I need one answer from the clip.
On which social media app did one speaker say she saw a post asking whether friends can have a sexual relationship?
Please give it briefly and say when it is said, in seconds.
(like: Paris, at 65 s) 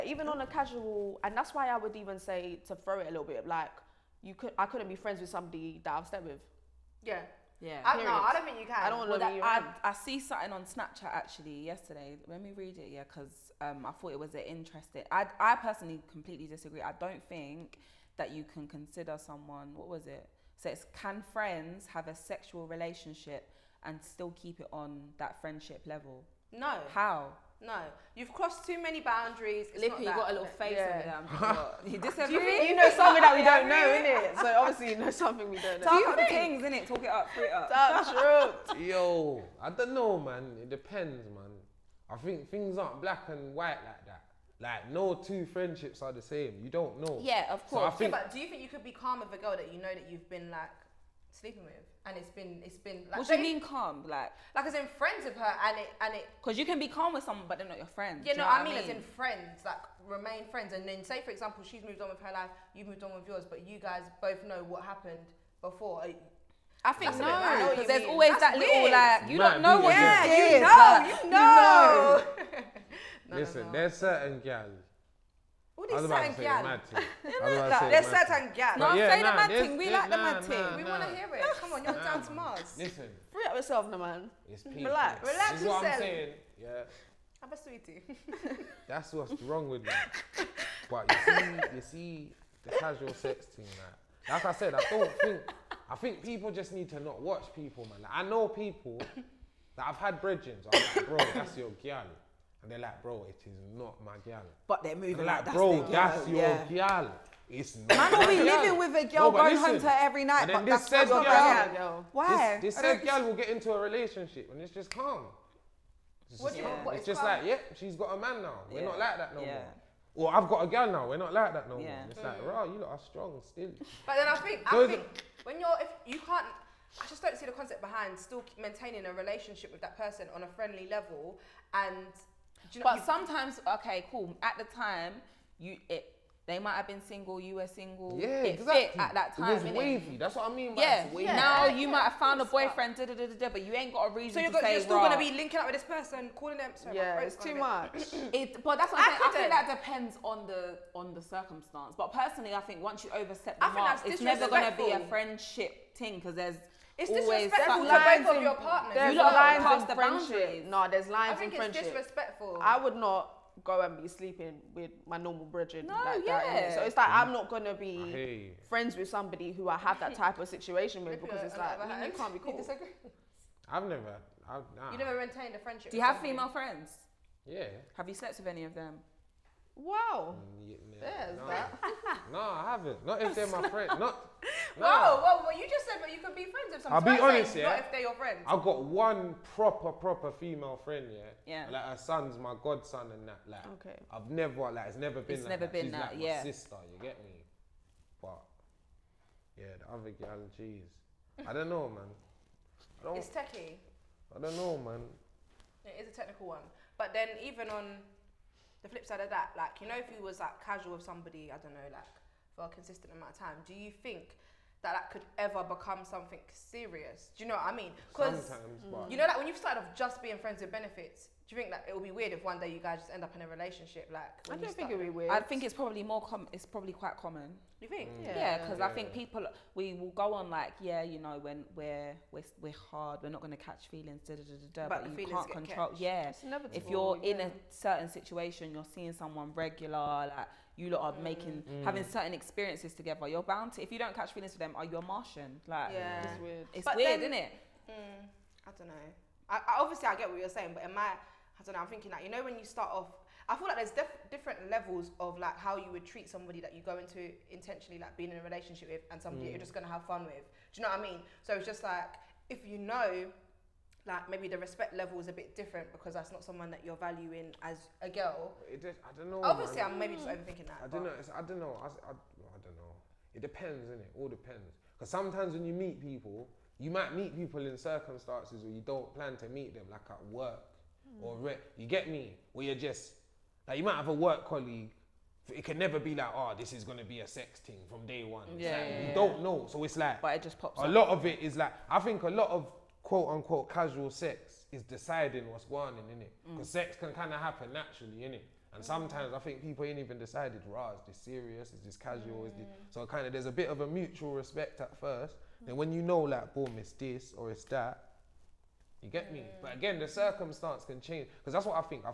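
Snapchat, at 10 s.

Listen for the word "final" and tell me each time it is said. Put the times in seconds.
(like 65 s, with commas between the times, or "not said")
not said.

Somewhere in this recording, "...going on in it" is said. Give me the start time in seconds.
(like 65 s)
295 s.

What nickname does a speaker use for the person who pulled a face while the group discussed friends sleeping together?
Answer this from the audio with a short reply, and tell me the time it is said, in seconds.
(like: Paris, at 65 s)
Lippy, at 29 s.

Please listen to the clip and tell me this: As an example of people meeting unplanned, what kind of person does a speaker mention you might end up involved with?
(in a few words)
A work colleague.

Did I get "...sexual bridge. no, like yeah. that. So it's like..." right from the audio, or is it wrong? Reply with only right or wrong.
wrong.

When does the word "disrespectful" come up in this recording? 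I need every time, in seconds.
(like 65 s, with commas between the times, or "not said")
157 s, 161 s.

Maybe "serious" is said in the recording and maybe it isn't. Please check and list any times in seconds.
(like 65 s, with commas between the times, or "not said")
216 s, 301 s.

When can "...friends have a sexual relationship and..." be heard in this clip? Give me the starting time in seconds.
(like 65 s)
21 s.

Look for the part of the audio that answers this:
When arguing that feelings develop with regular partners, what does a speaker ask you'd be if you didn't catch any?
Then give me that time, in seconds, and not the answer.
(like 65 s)
244 s.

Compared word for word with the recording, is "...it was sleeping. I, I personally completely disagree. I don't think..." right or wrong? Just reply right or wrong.
wrong.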